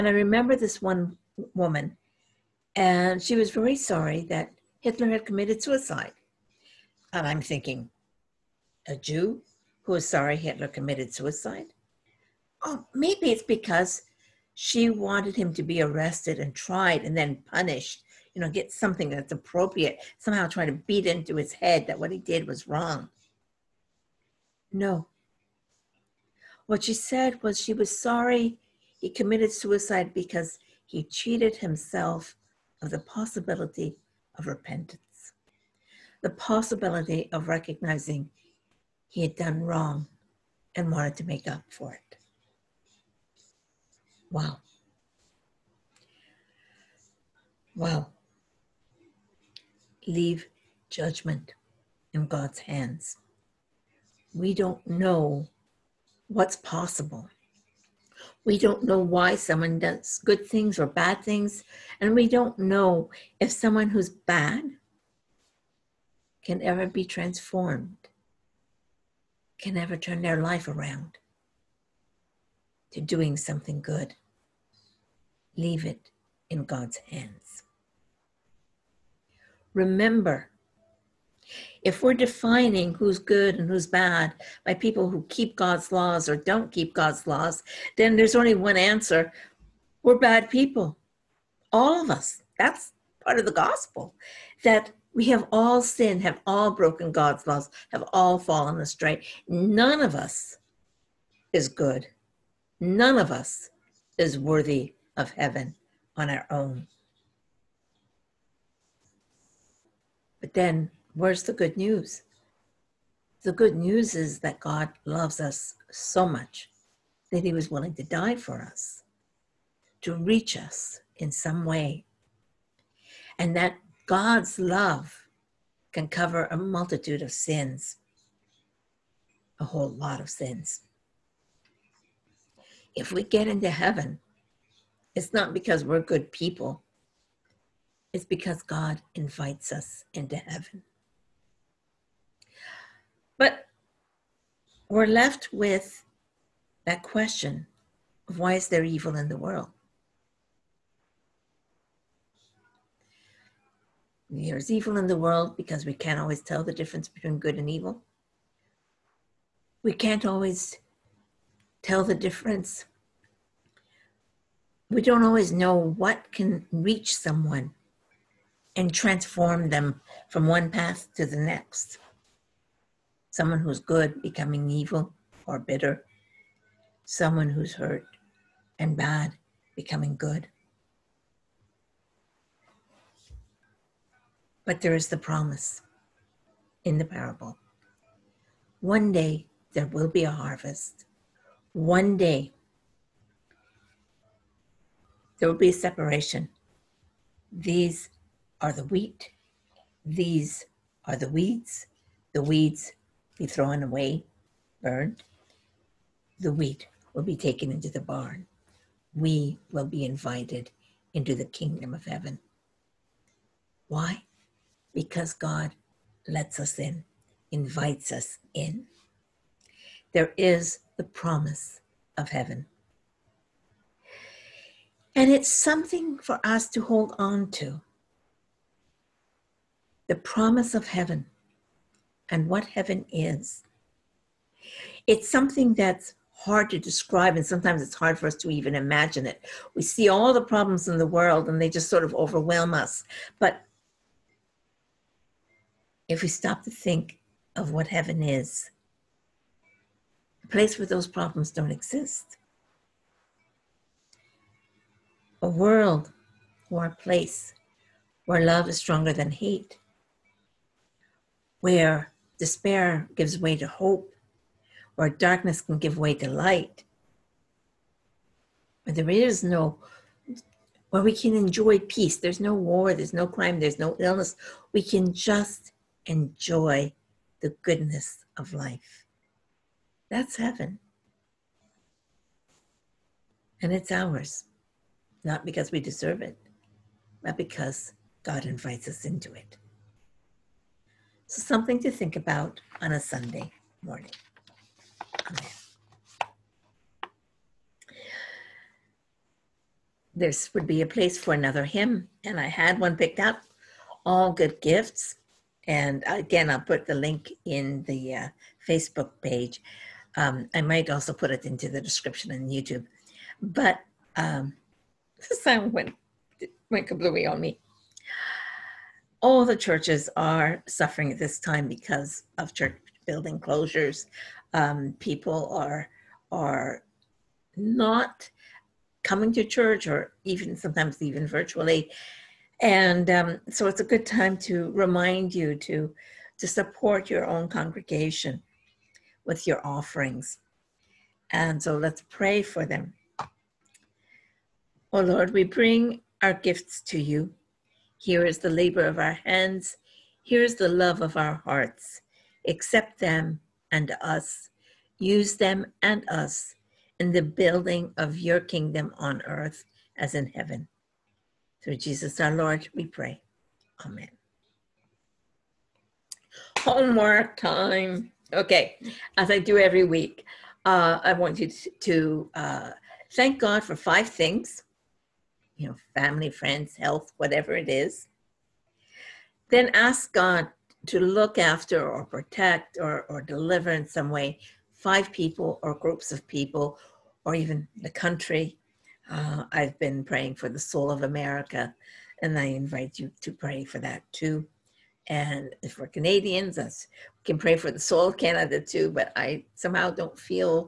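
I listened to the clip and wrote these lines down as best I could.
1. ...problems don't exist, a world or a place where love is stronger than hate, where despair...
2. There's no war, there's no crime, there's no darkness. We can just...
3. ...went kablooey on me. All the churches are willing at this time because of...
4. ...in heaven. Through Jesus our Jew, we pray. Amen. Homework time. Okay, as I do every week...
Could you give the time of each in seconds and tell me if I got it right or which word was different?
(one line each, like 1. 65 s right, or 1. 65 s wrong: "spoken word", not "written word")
1. 251 s right
2. 272 s wrong: "illness", not "darkness"
3. 316 s wrong: "suffering", not "willing"
4. 360 s wrong: "Lord", not "Jew".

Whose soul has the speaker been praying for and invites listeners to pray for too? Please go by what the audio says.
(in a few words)
America.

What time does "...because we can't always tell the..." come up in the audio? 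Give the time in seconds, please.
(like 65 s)
155 s.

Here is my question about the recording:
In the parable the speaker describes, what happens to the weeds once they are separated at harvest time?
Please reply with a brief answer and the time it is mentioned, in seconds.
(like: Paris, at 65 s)
Thrown away, burned, at 203 s.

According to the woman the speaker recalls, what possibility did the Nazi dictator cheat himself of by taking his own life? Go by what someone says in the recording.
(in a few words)
Repentance.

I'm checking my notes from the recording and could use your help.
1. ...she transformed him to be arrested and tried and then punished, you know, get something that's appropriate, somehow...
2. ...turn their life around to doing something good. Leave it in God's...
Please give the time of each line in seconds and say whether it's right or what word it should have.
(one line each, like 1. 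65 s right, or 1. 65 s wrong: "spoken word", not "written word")
1. 14 s wrong: "wanted", not "transformed"
2. 69 s right.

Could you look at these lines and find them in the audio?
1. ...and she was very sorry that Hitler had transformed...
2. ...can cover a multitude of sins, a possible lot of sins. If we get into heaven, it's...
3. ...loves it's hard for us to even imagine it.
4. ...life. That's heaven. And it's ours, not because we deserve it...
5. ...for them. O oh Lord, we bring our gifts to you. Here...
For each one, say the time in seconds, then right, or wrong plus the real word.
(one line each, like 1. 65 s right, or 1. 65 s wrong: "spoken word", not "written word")
1. 2 s wrong: "committed", not "transformed"
2. 125 s wrong: "whole", not "possible"
3. 237 s wrong: "sometimes", not "loves"
4. 278 s right
5. 342 s right.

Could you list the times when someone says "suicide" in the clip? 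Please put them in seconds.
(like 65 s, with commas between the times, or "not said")
5 s, 11 s, 29 s.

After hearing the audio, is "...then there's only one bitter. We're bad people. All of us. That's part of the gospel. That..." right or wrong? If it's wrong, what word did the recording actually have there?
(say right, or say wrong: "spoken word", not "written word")
wrong: "answer", not "bitter".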